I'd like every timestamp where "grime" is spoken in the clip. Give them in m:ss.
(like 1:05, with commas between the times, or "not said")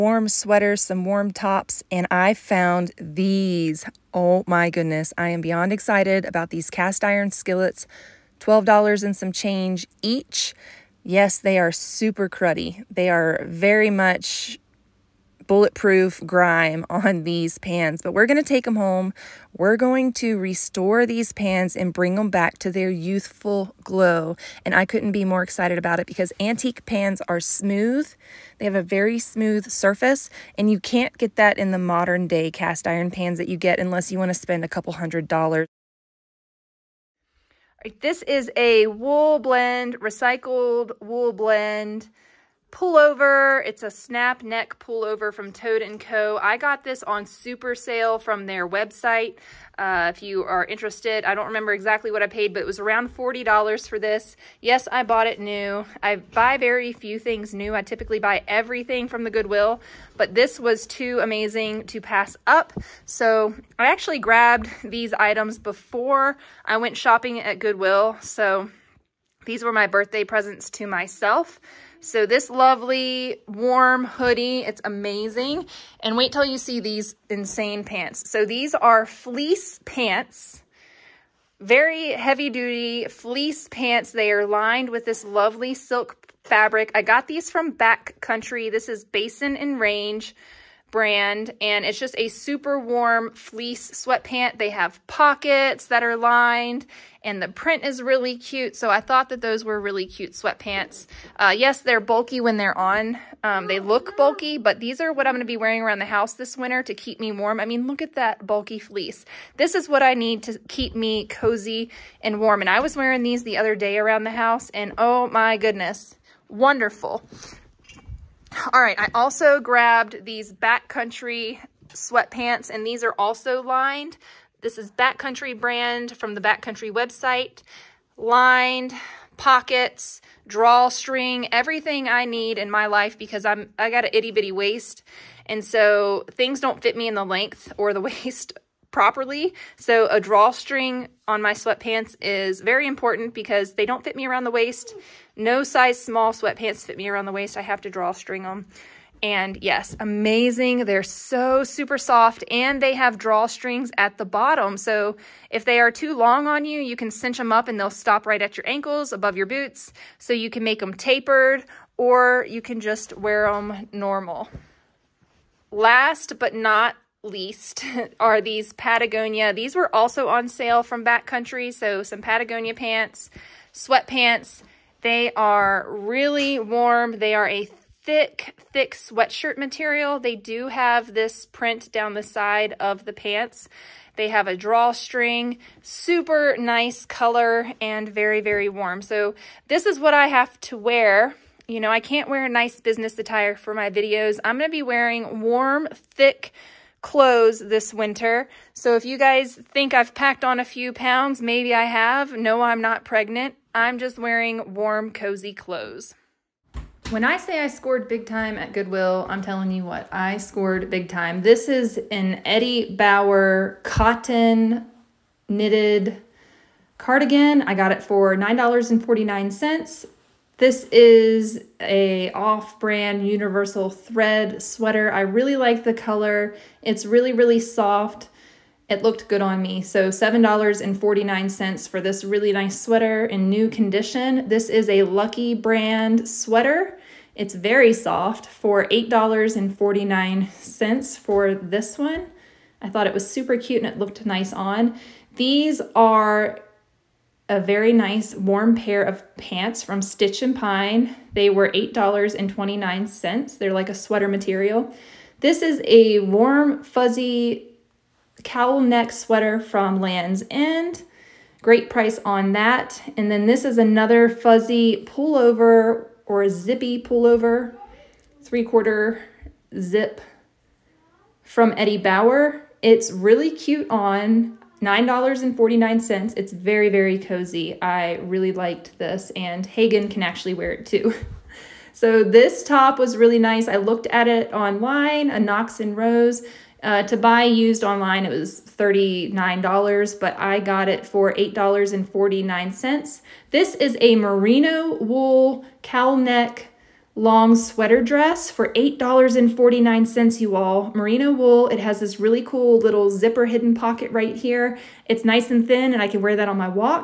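0:16.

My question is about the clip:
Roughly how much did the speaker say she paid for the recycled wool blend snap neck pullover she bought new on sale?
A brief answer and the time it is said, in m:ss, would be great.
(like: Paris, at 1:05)
$40, at 0:53.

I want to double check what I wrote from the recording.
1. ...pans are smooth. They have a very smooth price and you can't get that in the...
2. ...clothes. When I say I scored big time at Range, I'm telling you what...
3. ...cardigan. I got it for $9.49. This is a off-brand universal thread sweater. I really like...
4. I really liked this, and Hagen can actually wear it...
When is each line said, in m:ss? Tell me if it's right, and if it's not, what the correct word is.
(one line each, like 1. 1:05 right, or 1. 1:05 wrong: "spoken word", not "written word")
1. 0:26 wrong: "surface", not "price"
2. 3:25 wrong: "Goodwill", not "Range"
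3. 3:36 right
4. 4:37 right.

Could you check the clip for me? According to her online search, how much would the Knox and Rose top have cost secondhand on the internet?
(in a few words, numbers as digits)
$39.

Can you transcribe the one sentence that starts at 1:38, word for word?
So I thought that those were really cute sweatpants.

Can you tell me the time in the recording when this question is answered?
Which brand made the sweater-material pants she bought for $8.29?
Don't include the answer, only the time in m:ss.
4:09.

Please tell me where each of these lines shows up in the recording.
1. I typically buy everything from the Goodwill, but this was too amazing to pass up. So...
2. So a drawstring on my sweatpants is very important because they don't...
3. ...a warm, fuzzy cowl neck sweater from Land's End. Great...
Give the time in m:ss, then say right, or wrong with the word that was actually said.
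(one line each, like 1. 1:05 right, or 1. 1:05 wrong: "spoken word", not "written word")
1. 0:57 right
2. 2:19 right
3. 4:15 right.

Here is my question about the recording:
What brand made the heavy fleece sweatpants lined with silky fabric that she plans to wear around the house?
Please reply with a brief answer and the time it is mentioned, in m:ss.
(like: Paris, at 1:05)
Basin and Range, at 1:29.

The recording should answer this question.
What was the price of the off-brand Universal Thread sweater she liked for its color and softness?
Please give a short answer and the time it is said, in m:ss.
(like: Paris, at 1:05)
$7.49, at 3:50.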